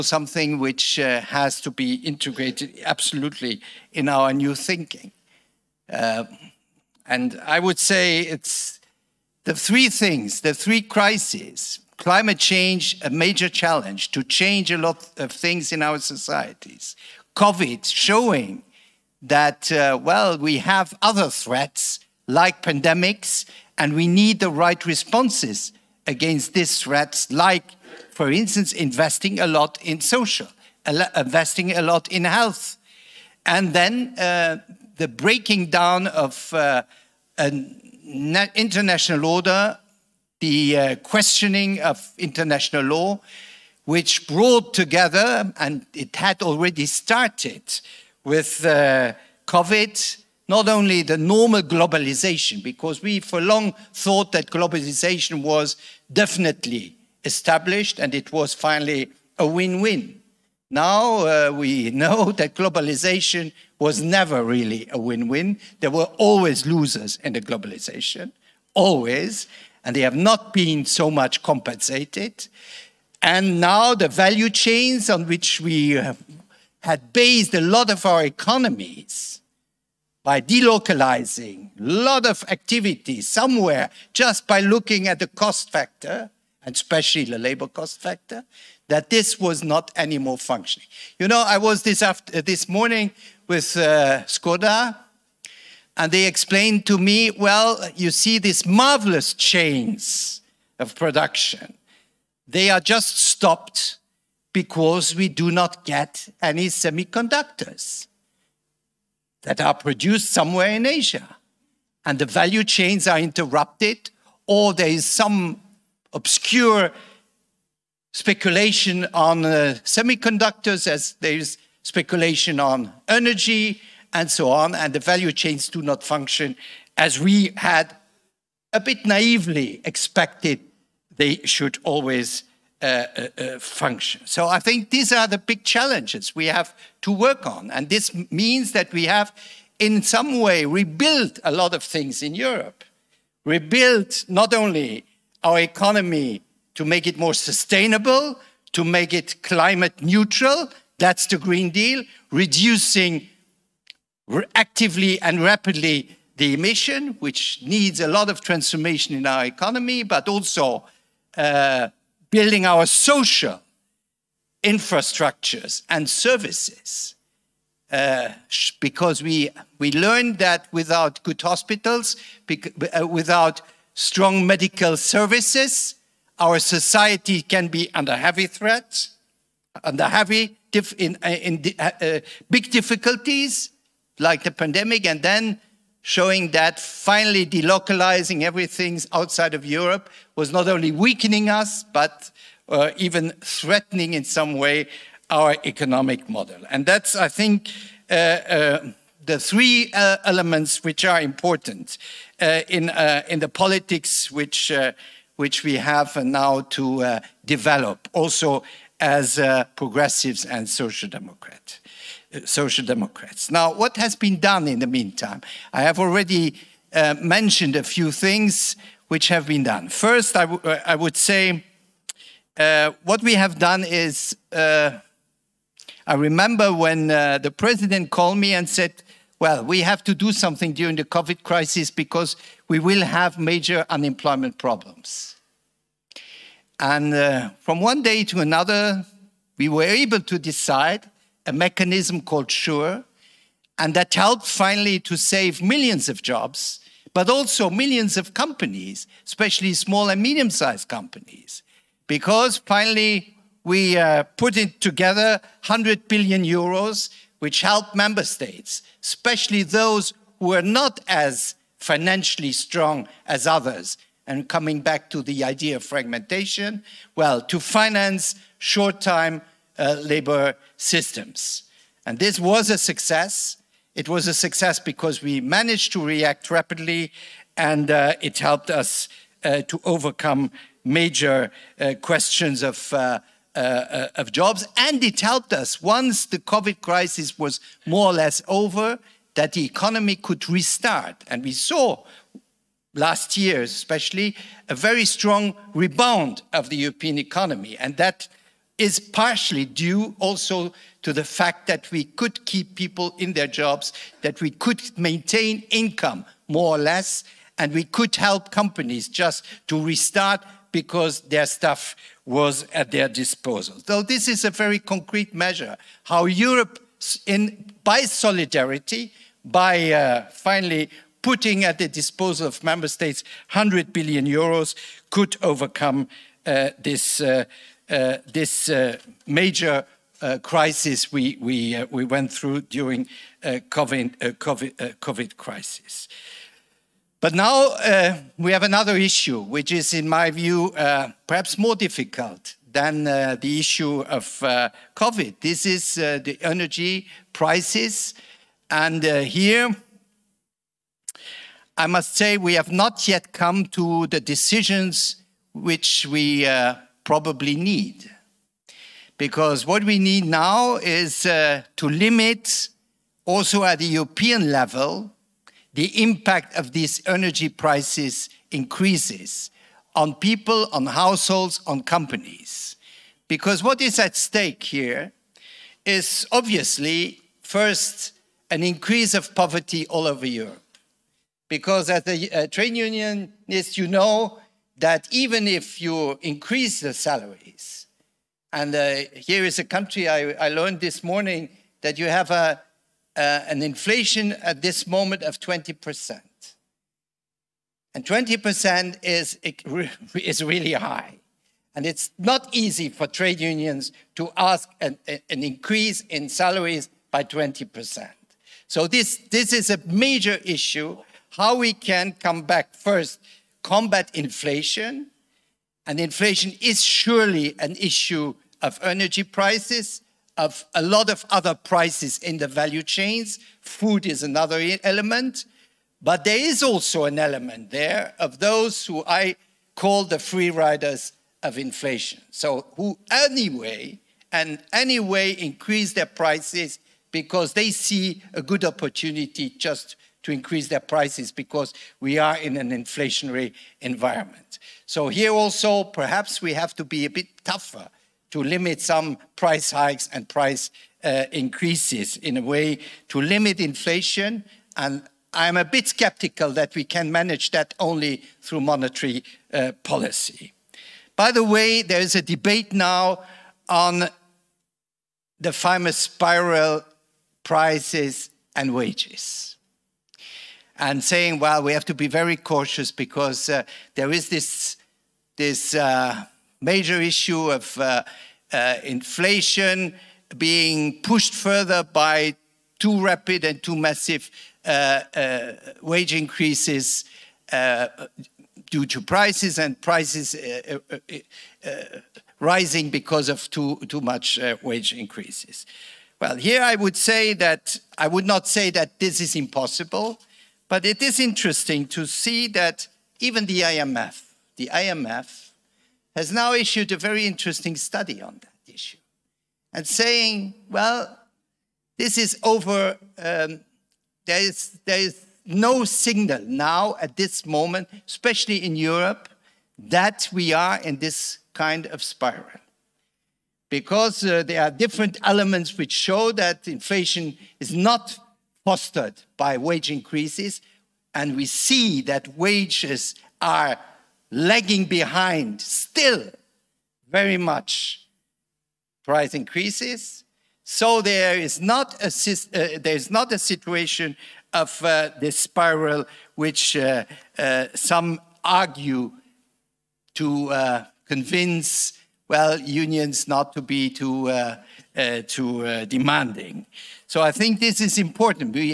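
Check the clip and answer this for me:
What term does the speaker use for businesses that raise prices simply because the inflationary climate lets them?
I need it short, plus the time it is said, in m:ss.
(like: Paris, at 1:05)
free riders of inflation, at 7:10.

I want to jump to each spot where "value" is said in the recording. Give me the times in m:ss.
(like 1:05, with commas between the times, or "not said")
1:14, 1:52, 2:04, 7:02.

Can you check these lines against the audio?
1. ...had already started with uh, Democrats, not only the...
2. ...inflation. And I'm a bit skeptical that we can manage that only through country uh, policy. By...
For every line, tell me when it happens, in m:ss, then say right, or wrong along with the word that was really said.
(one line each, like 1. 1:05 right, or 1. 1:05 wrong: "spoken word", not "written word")
1. 0:46 wrong: "COVID", not "Democrats"
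2. 7:33 wrong: "monetary", not "country".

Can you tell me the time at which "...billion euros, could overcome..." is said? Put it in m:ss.
5:23.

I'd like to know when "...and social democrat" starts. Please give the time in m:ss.
3:30.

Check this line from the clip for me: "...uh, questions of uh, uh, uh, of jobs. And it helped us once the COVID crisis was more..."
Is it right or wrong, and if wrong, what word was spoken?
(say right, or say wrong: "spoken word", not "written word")
right.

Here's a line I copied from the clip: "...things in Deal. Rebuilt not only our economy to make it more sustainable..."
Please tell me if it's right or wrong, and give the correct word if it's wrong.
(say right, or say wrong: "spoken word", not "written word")
wrong: "Europe", not "Deal".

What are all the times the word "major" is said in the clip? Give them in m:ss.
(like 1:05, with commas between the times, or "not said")
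0:13, 3:53, 4:40, 5:29, 6:49, 7:56.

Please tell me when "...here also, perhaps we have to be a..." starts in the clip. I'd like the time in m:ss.
7:25.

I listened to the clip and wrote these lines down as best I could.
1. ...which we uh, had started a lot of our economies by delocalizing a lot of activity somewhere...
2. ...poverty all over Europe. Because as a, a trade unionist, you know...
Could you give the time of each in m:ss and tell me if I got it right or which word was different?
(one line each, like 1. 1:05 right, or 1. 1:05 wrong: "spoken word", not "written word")
1. 1:15 wrong: "based", not "started"
2. 6:19 right.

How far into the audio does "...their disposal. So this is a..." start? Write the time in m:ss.
5:12.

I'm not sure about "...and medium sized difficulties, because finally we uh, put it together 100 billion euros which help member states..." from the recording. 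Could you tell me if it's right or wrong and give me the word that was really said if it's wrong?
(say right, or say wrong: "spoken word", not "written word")
wrong: "companies", not "difficulties".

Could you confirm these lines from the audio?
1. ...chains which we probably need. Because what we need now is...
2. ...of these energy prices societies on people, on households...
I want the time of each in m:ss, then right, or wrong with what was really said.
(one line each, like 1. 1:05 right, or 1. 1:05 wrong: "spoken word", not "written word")
1. 5:54 wrong: "decisions", not "chains"
2. 6:06 wrong: "increases", not "societies".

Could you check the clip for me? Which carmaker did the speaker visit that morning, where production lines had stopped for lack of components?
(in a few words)
Skoda.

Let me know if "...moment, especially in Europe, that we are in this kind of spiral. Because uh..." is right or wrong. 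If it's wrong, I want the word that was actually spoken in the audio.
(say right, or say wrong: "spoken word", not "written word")
right.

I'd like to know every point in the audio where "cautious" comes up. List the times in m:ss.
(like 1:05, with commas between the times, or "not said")
7:52.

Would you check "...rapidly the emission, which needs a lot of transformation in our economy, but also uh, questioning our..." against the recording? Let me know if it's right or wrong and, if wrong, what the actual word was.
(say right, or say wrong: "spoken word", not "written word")
wrong: "building", not "questioning".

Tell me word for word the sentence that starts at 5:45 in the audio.
This is uh, the energy prices.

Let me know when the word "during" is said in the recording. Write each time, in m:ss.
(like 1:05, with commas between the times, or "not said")
3:50, 5:32.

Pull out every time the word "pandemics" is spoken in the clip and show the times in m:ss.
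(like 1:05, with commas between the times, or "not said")
0:22, 3:04.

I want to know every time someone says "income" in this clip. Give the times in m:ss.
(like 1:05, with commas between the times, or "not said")
5:05.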